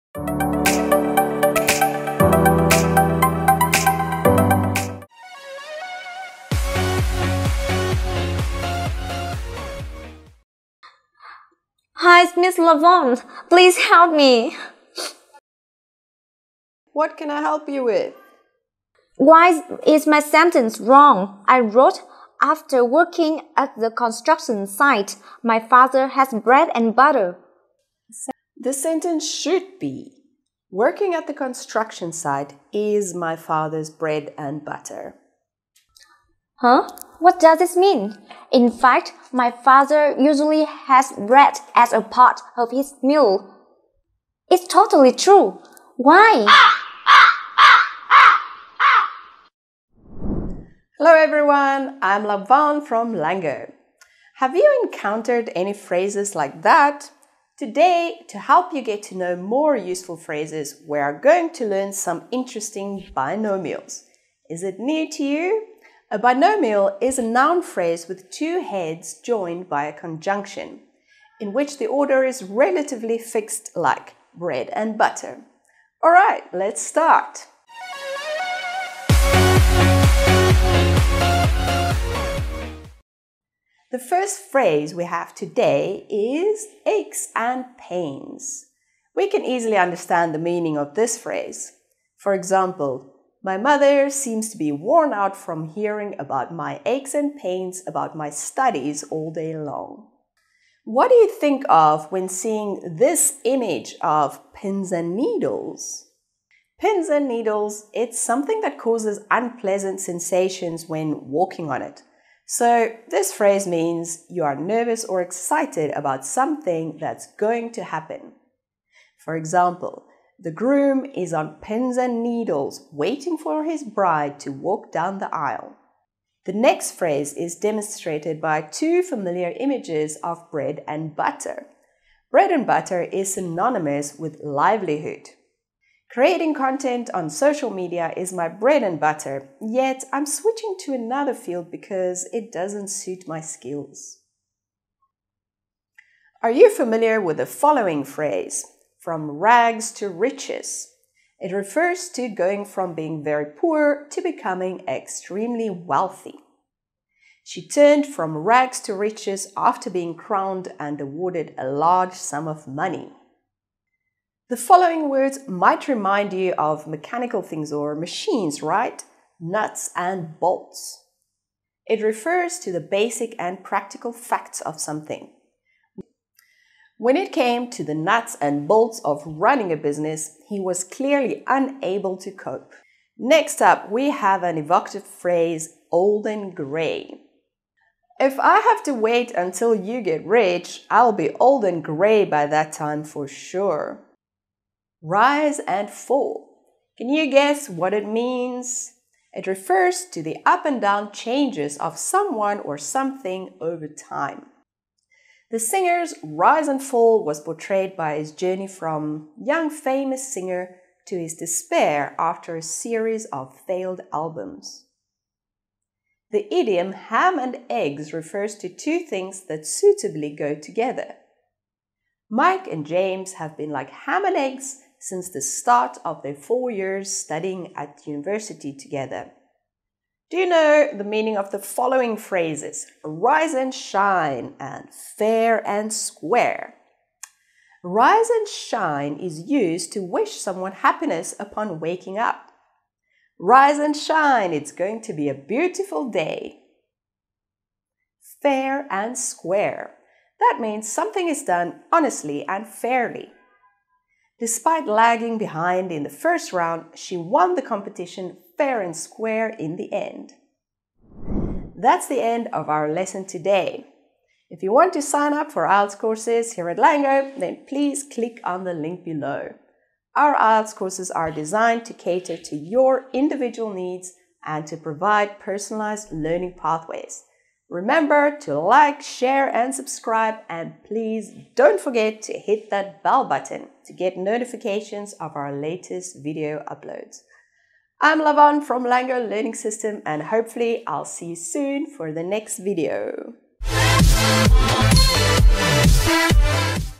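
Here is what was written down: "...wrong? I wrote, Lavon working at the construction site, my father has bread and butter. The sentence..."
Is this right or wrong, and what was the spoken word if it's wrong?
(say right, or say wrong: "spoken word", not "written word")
wrong: "After", not "Lavon".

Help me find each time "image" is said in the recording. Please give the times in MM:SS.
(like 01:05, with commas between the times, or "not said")
01:43, 02:09.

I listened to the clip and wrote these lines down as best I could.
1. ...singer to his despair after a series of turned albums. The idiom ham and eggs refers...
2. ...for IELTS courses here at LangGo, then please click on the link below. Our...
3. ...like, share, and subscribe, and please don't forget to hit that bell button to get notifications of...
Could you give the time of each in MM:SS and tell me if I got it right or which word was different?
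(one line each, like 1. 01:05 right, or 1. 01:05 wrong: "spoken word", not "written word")
1. 03:30 wrong: "failed", not "turned"
2. 04:25 right
3. 04:38 right.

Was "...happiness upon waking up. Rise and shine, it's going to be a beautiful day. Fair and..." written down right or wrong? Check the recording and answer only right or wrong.
right.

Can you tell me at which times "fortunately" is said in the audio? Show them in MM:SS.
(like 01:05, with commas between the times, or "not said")
not said.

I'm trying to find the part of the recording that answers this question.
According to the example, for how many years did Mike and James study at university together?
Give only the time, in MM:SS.
03:46.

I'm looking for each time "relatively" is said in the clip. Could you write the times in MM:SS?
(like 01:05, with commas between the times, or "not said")
01:12.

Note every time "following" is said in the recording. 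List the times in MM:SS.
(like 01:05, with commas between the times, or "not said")
02:27, 02:44, 03:51.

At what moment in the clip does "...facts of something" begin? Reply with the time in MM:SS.
02:54.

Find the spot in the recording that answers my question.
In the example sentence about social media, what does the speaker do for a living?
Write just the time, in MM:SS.
02:16.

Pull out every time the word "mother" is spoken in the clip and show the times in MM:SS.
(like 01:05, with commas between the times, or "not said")
01:33.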